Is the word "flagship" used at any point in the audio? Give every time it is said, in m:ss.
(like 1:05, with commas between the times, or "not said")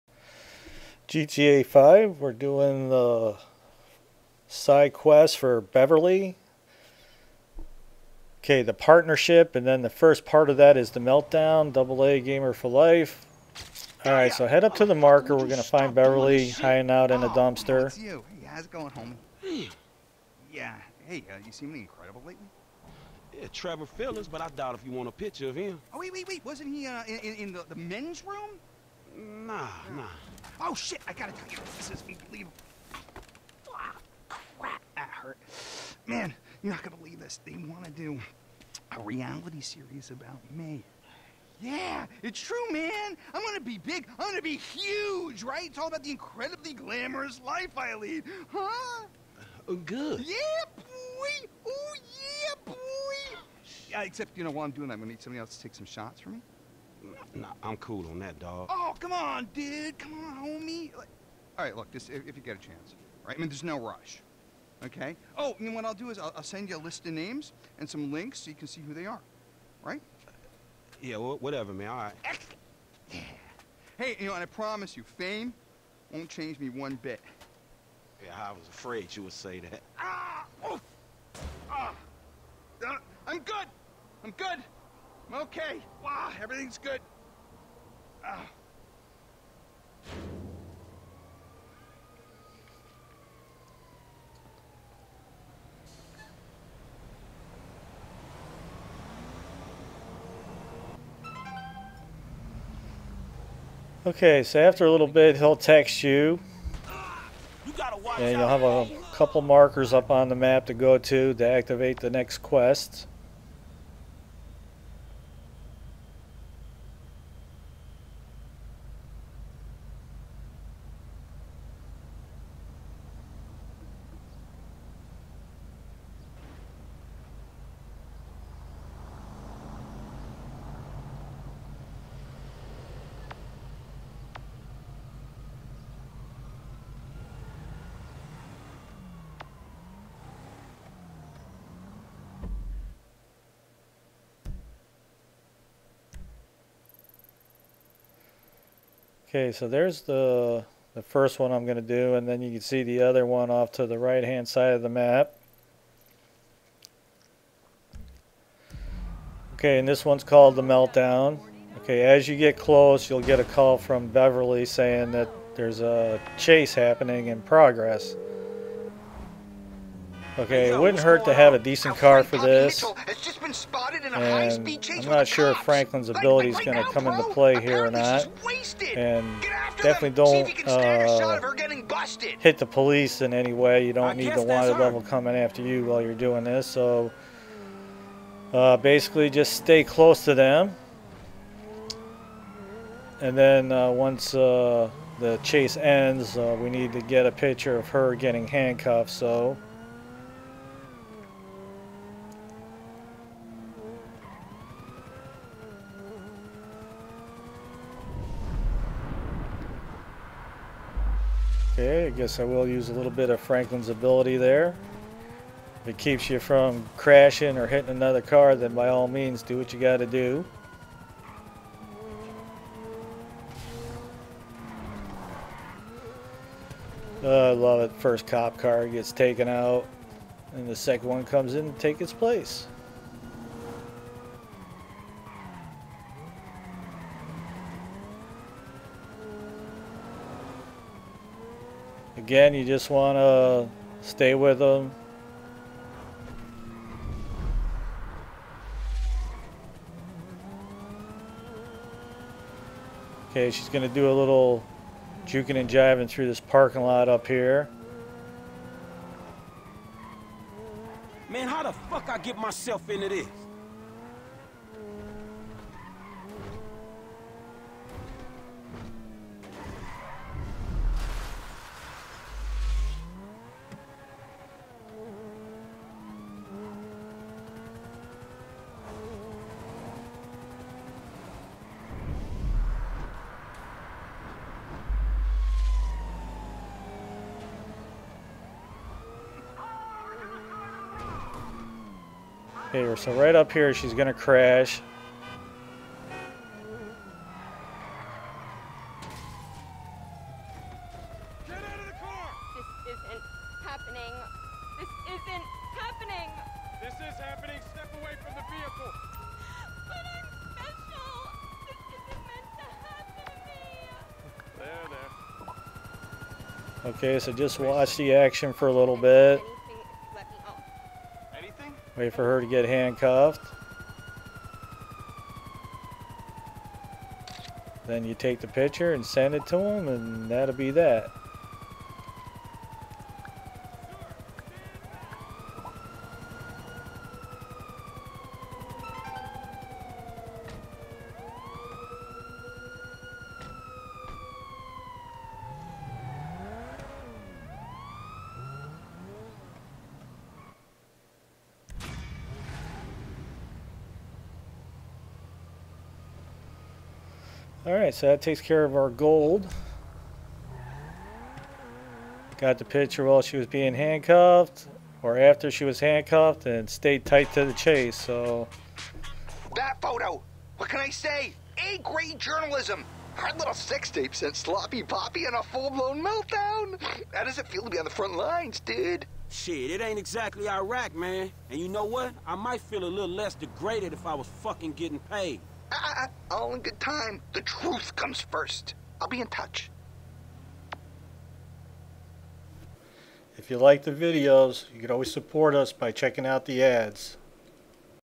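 not said.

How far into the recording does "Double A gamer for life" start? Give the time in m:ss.
0:11.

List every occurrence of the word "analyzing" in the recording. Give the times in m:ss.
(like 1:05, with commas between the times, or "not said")
not said.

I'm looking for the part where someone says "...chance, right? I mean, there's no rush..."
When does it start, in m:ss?
1:02.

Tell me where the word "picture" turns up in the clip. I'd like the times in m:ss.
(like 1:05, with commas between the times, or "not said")
0:25, 3:17, 5:28, 6:02.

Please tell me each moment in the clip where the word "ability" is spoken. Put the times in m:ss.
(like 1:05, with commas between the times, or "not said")
2:56, 3:33.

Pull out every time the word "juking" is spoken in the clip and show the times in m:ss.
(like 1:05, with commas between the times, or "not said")
4:15.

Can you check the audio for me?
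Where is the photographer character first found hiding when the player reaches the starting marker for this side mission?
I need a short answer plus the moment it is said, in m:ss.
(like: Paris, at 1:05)
A dumpster, at 0:17.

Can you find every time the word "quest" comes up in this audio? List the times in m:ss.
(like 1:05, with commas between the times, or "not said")
0:04, 1:52.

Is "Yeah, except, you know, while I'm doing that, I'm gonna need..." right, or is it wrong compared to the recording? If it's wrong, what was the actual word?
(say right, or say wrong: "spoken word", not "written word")
right.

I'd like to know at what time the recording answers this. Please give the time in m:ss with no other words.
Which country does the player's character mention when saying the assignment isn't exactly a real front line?
6:20.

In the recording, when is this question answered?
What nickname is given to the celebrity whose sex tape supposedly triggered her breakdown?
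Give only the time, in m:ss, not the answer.
6:14.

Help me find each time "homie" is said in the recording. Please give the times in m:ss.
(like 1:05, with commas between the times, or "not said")
0:18, 1:00.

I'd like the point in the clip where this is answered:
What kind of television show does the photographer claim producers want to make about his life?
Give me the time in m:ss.
0:39.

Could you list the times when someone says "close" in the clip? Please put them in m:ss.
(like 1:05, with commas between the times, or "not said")
2:42, 3:09.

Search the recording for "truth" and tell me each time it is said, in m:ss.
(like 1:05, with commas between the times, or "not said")
6:27.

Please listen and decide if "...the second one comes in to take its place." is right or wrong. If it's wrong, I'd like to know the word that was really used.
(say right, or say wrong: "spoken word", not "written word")
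right.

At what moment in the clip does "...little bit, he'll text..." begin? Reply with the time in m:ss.
1:44.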